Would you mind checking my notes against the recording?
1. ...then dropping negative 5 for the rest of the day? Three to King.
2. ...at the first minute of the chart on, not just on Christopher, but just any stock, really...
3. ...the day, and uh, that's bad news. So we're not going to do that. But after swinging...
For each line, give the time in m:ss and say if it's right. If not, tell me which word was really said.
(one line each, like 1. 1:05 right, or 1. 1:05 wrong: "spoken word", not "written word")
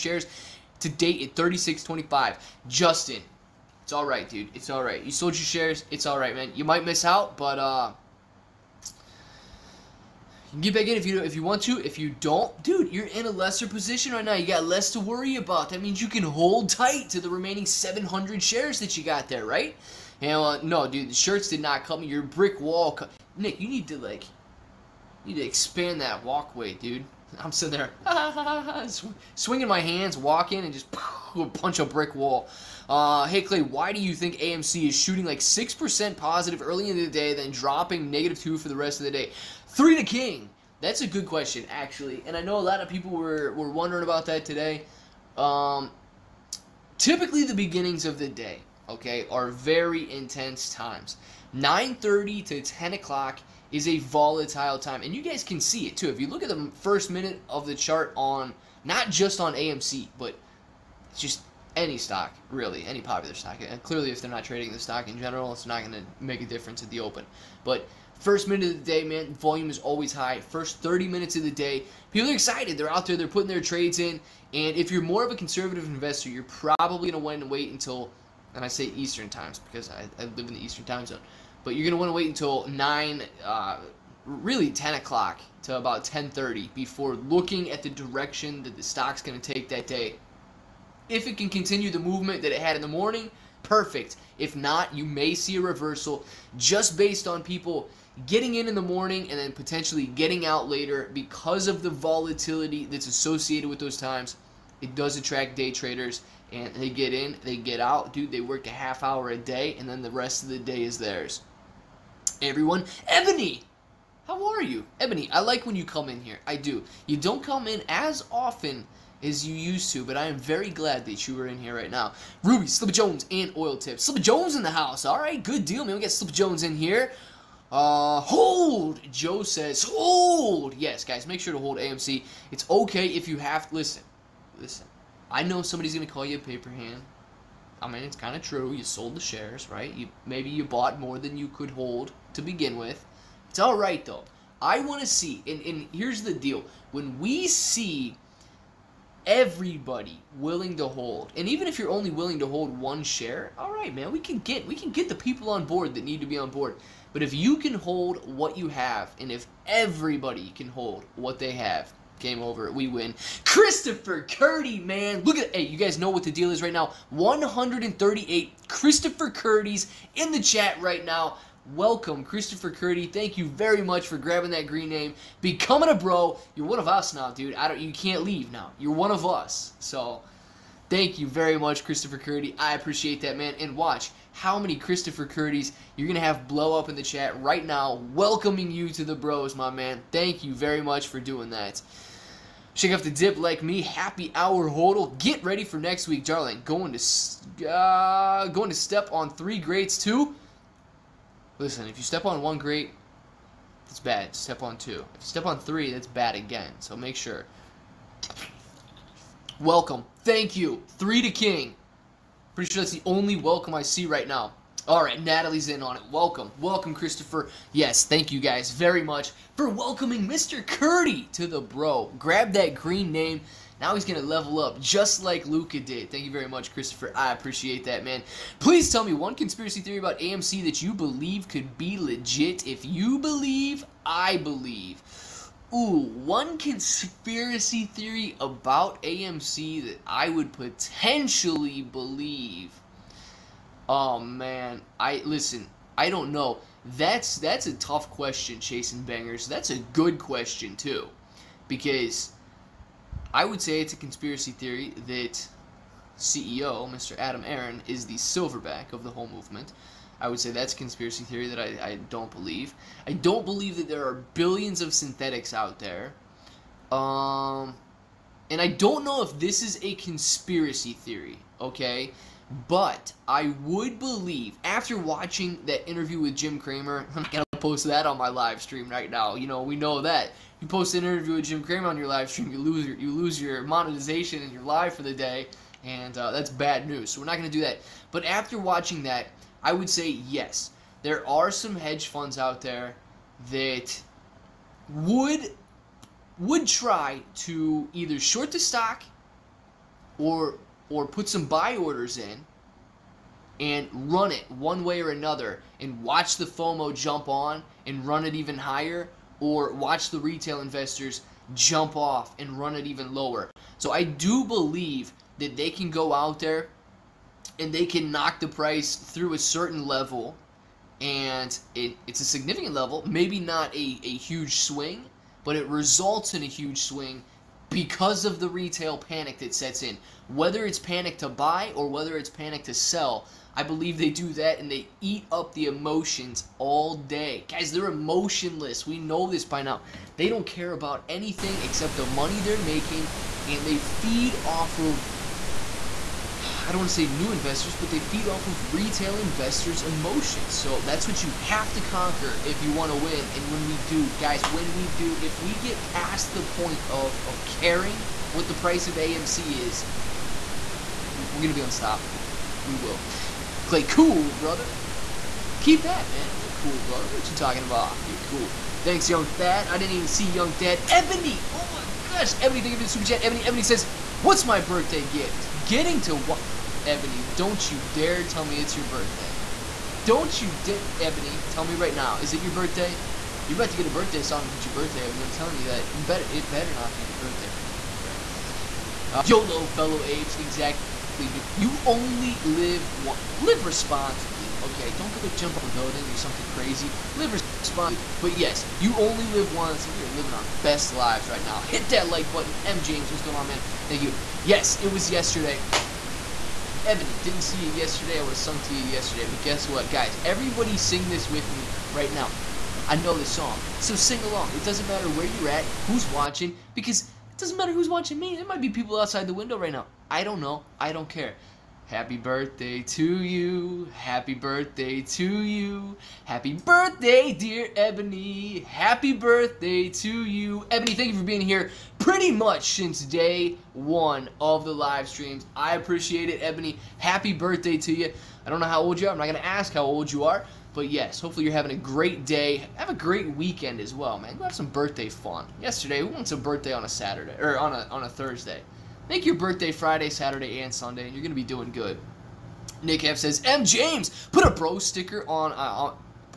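1. 0:37 wrong: "2", not "5"
2. 0:56 wrong: "AMC", not "Christopher"
3. 4:45 wrong: "watching", not "swinging".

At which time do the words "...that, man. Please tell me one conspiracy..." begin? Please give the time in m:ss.
3:47.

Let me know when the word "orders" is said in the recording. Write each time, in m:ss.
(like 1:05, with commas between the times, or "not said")
5:01.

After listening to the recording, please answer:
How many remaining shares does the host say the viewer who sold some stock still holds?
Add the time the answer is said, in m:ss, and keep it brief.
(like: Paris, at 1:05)
700, at 0:17.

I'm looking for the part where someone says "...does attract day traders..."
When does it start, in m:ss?
1:44.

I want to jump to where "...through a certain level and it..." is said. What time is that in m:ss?
5:18.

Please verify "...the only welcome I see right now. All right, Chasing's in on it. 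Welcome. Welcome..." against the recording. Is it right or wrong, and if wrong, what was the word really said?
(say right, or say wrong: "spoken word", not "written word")
wrong: "Natalie", not "Chasing".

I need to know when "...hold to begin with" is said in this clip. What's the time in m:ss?
2:21.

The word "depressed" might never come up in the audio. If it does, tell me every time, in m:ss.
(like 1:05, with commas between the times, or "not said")
not said.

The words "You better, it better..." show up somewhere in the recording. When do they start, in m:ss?
6:25.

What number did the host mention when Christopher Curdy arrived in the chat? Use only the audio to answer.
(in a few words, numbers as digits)
138.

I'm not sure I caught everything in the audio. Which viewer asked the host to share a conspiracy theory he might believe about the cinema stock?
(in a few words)
Chasing Bangers.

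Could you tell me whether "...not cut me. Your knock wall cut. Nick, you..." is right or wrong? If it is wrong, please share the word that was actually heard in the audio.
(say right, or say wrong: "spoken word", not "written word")
wrong: "brick", not "knock".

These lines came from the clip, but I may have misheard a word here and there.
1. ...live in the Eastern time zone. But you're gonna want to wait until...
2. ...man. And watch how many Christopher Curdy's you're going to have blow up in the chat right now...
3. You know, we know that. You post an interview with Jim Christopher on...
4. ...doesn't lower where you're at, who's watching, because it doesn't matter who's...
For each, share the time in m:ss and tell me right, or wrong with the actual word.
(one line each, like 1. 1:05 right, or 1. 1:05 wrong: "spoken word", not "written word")
1. 1:20 right
2. 3:03 right
3. 4:39 wrong: "Cramer", not "Christopher"
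4. 6:54 wrong: "matter", not "lower".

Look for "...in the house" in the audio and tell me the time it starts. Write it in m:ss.
2:04.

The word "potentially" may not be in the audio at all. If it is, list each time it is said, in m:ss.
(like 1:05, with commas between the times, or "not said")
1:39, 4:00.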